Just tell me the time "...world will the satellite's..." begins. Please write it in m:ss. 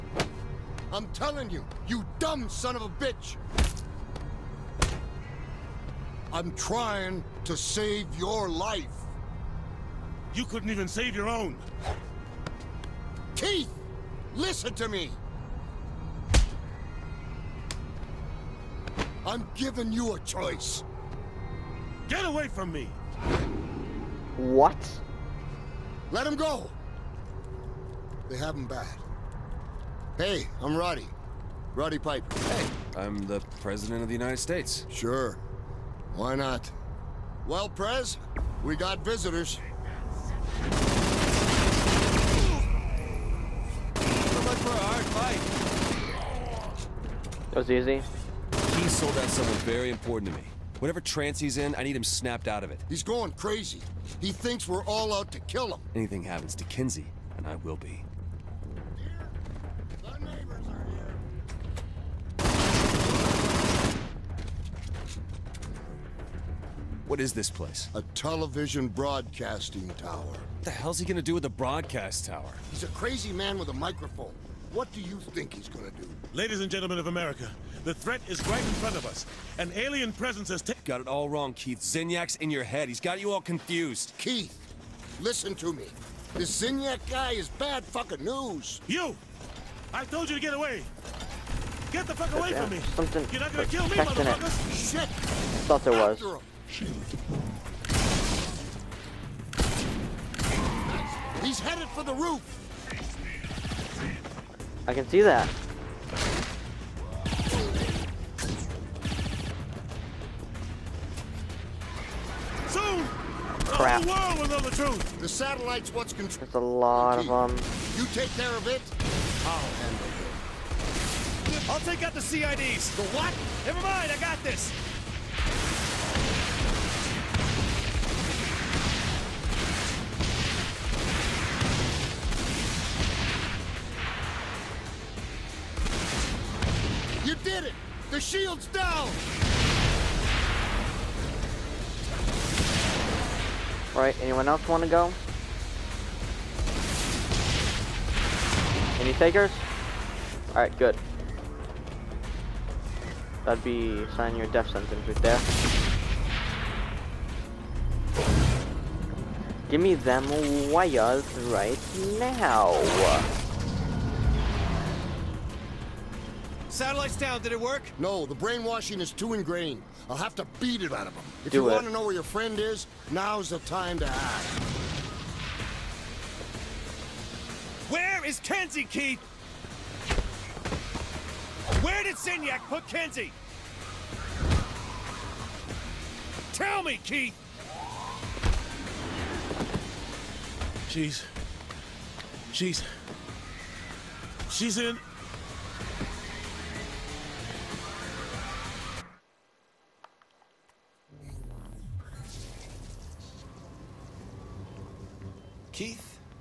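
1:54.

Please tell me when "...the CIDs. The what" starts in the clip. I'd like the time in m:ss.
2:02.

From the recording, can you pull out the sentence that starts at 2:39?
Give me them wires right now.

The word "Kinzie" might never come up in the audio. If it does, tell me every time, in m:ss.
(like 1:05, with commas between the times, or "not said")
0:56, 2:58, 3:02.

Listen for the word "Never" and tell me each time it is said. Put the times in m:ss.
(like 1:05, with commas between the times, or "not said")
2:03.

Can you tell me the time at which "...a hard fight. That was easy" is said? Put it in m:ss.
0:44.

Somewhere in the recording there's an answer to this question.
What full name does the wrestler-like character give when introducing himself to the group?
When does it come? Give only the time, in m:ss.
0:31.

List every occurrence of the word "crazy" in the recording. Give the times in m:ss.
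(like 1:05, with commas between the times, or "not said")
0:53, 1:12.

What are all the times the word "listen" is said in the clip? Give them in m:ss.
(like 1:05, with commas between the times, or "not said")
0:14, 1:25.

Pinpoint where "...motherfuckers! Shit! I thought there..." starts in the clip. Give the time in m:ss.
1:33.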